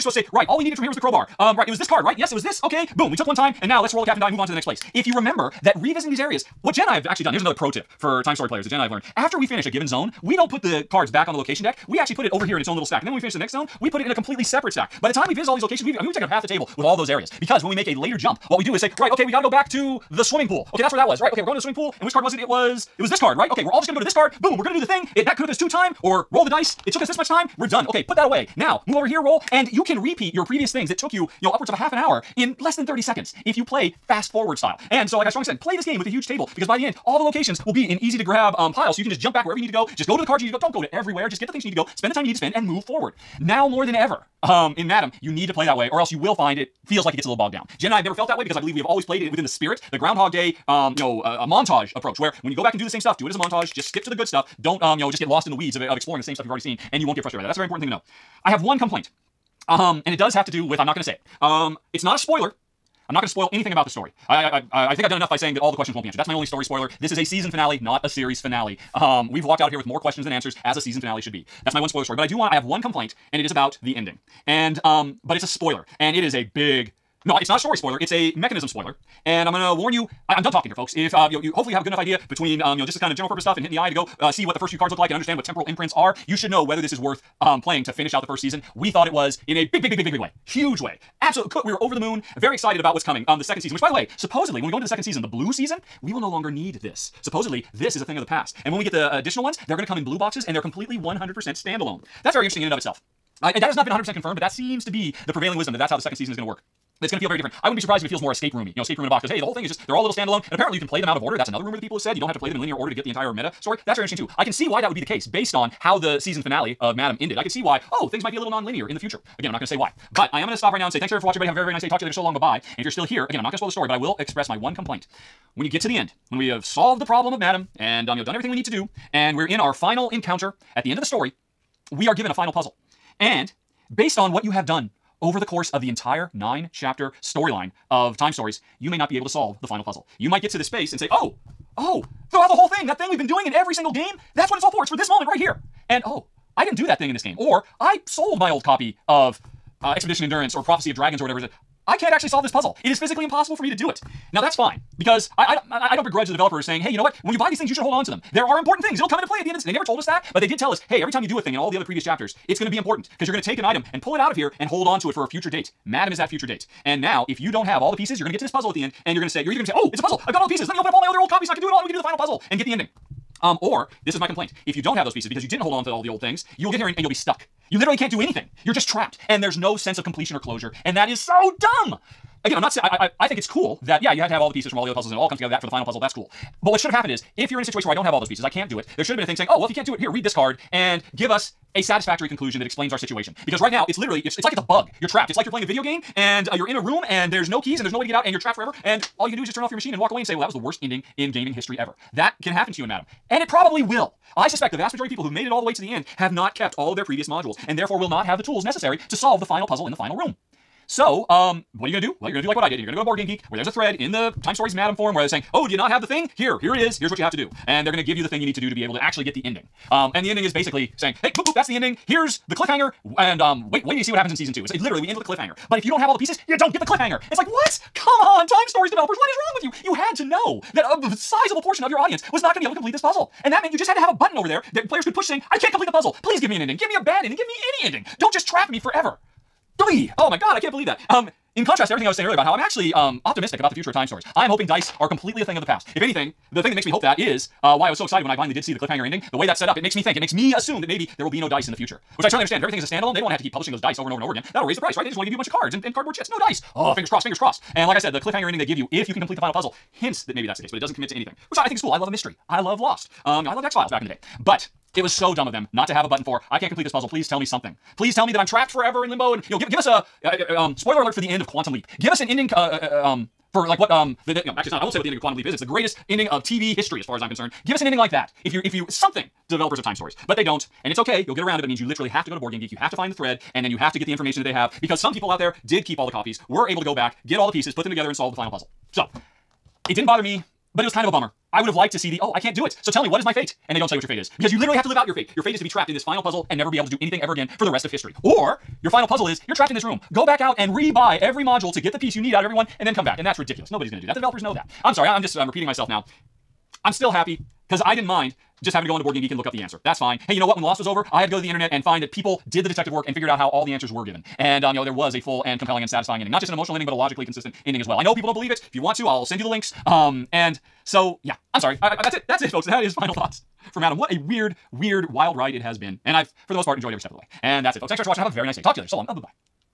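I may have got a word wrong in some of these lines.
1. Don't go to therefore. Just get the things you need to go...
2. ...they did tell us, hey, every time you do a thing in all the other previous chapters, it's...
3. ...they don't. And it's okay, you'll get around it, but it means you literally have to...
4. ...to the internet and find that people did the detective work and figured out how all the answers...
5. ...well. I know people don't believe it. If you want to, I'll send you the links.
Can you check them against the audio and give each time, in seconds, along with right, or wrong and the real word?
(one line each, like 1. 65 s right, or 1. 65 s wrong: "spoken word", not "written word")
1. 40 s wrong: "everywhere", not "therefore"
2. 160 s right
3. 280 s right
4. 311 s right
5. 317 s right.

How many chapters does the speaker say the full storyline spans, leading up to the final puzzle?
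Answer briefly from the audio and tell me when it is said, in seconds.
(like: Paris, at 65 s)
9, at 136 s.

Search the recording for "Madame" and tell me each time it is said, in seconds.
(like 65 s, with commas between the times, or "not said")
44 s, 116 s, 127 s, 165 s, 202 s, 214 s.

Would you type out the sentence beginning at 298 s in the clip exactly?
Or your final puzzle is you're trapped in this room.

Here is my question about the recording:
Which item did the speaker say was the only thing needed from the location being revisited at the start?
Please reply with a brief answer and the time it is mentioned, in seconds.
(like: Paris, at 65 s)
crowbar, at 0 s.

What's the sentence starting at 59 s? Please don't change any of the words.
Um, and it does have to do with, I'm not going to say it.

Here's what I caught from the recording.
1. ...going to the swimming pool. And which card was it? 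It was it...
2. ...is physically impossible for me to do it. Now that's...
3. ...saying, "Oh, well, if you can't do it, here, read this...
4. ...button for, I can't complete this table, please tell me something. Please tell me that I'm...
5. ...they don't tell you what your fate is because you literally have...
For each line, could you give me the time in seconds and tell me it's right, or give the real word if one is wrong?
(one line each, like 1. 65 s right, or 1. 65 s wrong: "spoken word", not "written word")
1. 21 s right
2. 152 s right
3. 189 s right
4. 266 s wrong: "puzzle", not "table"
5. 293 s right.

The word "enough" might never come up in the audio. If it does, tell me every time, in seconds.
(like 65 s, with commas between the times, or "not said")
65 s, 81 s.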